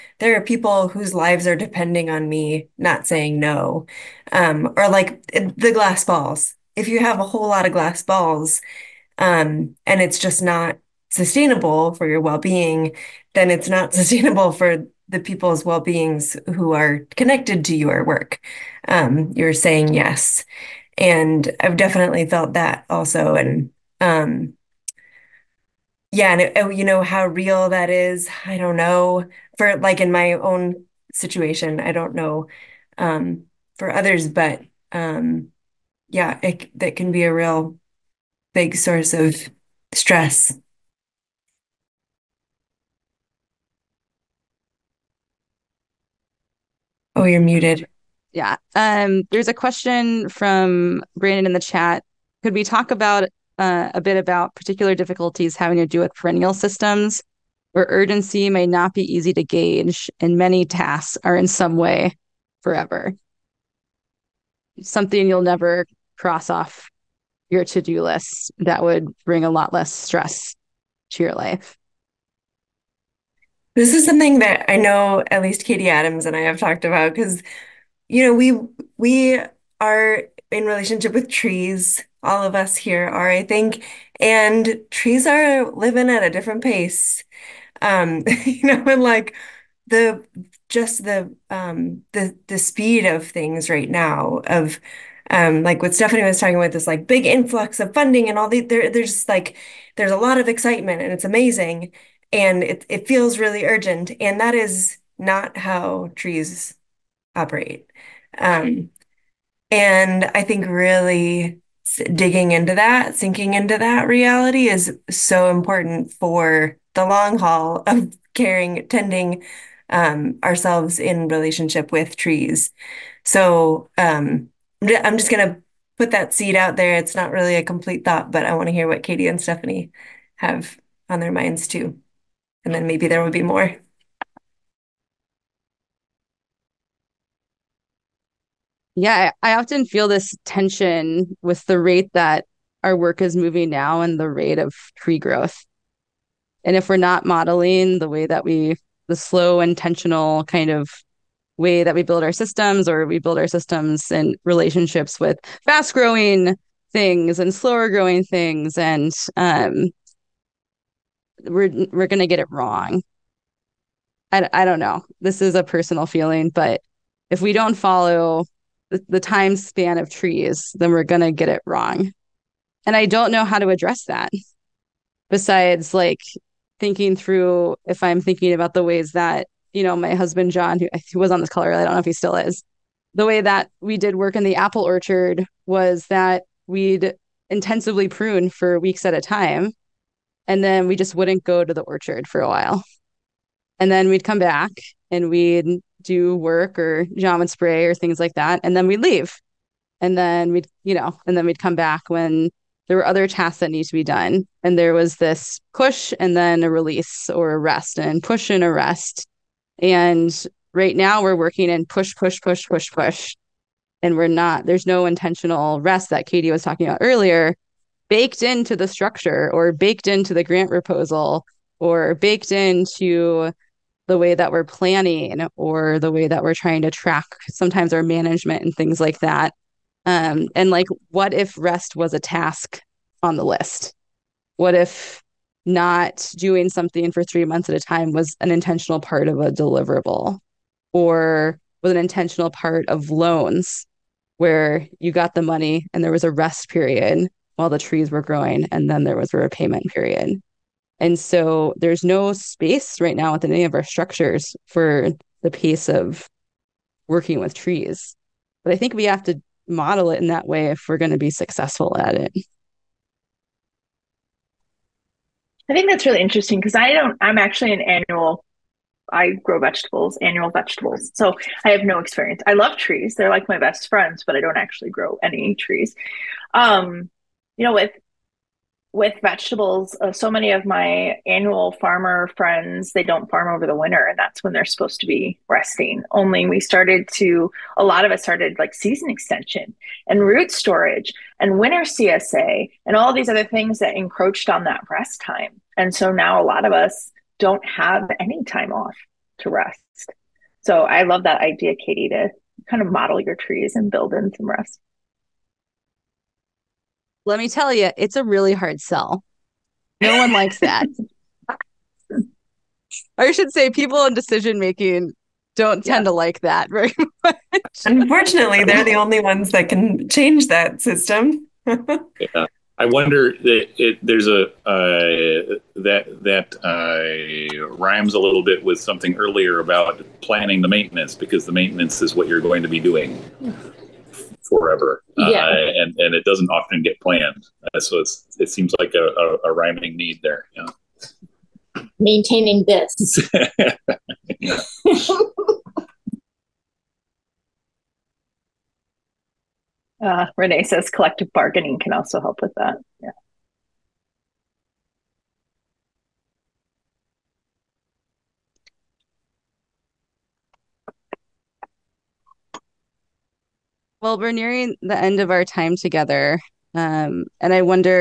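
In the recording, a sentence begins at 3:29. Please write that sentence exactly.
And right now we're working in push, push, push, push, push.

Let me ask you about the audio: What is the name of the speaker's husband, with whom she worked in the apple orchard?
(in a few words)
John.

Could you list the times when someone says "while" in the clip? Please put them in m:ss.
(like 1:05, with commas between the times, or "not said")
3:12, 4:07.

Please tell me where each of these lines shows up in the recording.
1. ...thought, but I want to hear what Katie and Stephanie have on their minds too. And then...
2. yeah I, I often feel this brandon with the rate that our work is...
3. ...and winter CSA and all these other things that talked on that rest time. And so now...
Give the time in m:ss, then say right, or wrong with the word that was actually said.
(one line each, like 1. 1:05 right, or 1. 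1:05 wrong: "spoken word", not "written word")
1. 2:08 right
2. 2:19 wrong: "tension", not "brandon"
3. 4:51 wrong: "encroached", not "talked".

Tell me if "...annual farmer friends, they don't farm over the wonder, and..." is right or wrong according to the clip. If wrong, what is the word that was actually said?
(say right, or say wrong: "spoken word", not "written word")
wrong: "winter", not "wonder".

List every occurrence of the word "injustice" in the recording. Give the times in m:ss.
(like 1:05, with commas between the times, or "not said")
not said.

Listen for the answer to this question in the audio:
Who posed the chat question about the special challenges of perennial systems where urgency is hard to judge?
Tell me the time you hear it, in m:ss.
0:51.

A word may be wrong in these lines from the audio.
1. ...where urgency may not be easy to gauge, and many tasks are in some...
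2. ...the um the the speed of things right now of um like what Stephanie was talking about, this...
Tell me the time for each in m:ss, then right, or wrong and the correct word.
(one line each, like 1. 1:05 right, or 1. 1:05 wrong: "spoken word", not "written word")
1. 0:57 right
2. 1:31 right.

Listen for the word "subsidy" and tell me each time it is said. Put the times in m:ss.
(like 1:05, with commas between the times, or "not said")
not said.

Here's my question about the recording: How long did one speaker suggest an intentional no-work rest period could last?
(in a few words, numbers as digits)
3 months.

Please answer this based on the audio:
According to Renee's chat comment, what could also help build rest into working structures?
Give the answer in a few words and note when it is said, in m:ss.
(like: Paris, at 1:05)
Collective bargaining, at 5:50.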